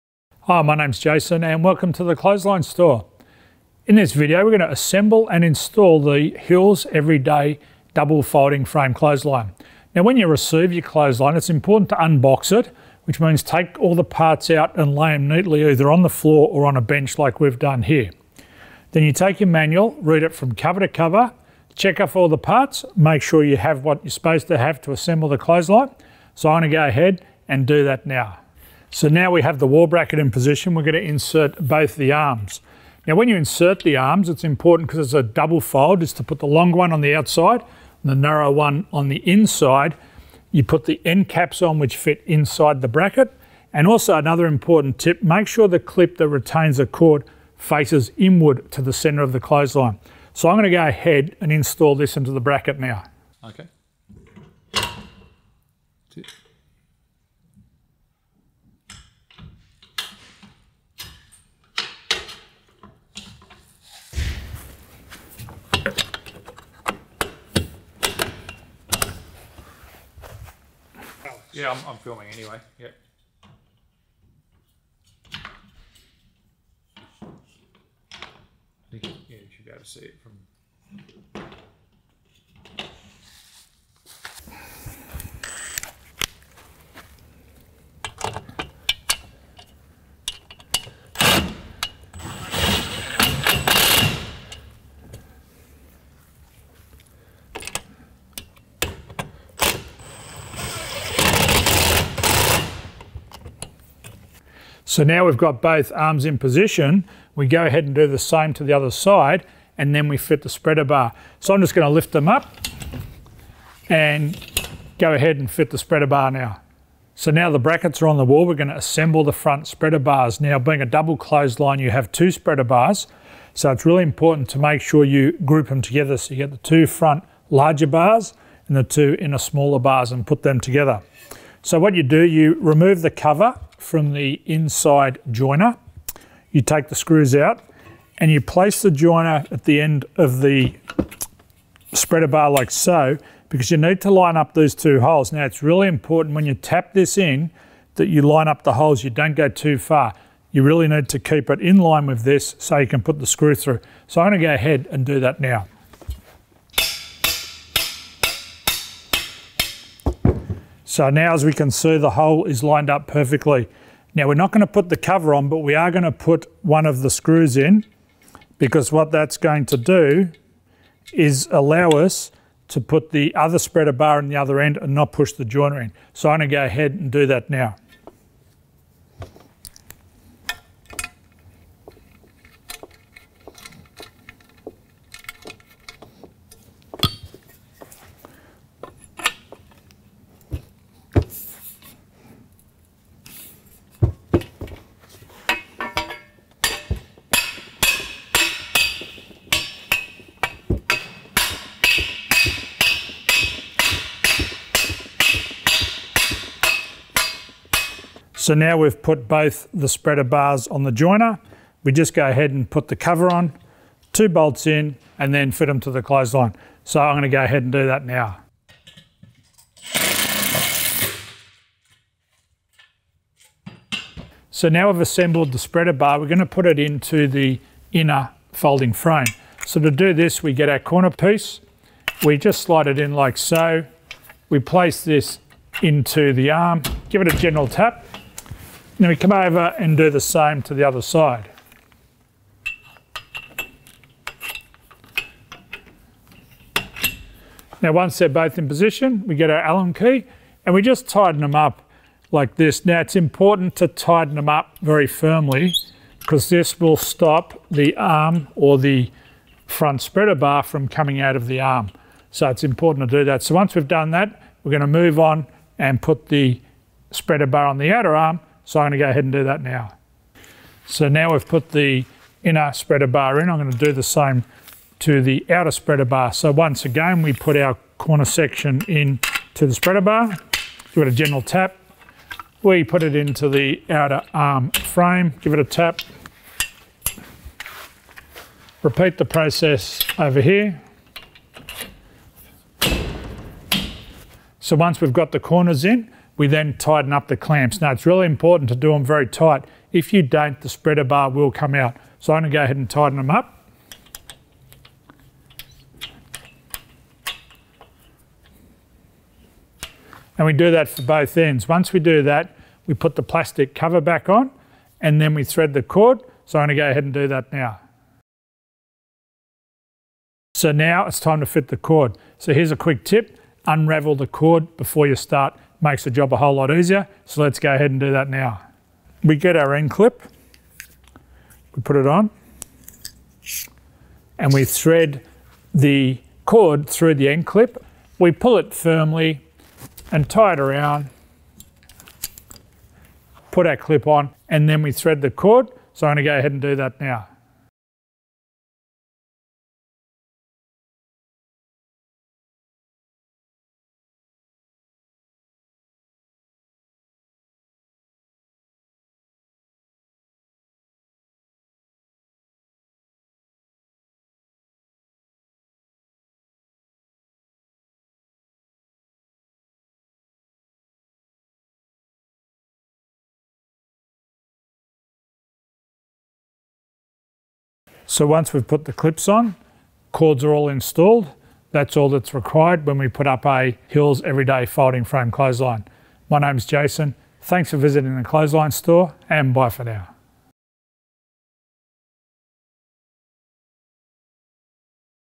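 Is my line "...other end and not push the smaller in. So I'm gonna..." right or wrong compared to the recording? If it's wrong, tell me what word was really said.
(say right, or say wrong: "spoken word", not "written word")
wrong: "joiner", not "smaller".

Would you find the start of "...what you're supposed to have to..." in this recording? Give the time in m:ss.
0:23.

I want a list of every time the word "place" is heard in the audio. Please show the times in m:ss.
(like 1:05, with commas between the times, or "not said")
2:18, 3:54.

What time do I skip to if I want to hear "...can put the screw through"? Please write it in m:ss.
2:32.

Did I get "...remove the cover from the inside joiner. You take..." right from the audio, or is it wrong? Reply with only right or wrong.
right.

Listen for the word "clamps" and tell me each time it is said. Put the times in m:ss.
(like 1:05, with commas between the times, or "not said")
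4:57.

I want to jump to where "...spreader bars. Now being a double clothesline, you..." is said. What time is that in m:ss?
1:59.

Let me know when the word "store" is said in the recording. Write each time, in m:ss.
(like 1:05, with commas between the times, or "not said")
0:02, 6:28.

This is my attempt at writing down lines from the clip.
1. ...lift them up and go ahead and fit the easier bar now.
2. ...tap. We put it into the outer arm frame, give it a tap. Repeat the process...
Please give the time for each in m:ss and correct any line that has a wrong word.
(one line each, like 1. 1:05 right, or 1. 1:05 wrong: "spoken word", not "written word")
1. 1:51 wrong: "spreader", not "easier"
2. 4:41 right.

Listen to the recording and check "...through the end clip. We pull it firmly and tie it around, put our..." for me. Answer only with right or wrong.
right.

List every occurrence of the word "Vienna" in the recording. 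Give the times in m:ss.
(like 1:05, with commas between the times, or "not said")
not said.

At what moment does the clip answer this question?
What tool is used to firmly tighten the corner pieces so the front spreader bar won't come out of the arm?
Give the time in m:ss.
4:09.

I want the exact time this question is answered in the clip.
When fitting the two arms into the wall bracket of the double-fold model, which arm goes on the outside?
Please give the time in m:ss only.
0:36.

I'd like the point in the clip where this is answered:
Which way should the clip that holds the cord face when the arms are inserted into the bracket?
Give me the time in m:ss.
0:48.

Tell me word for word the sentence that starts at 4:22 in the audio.
So it's important to do that.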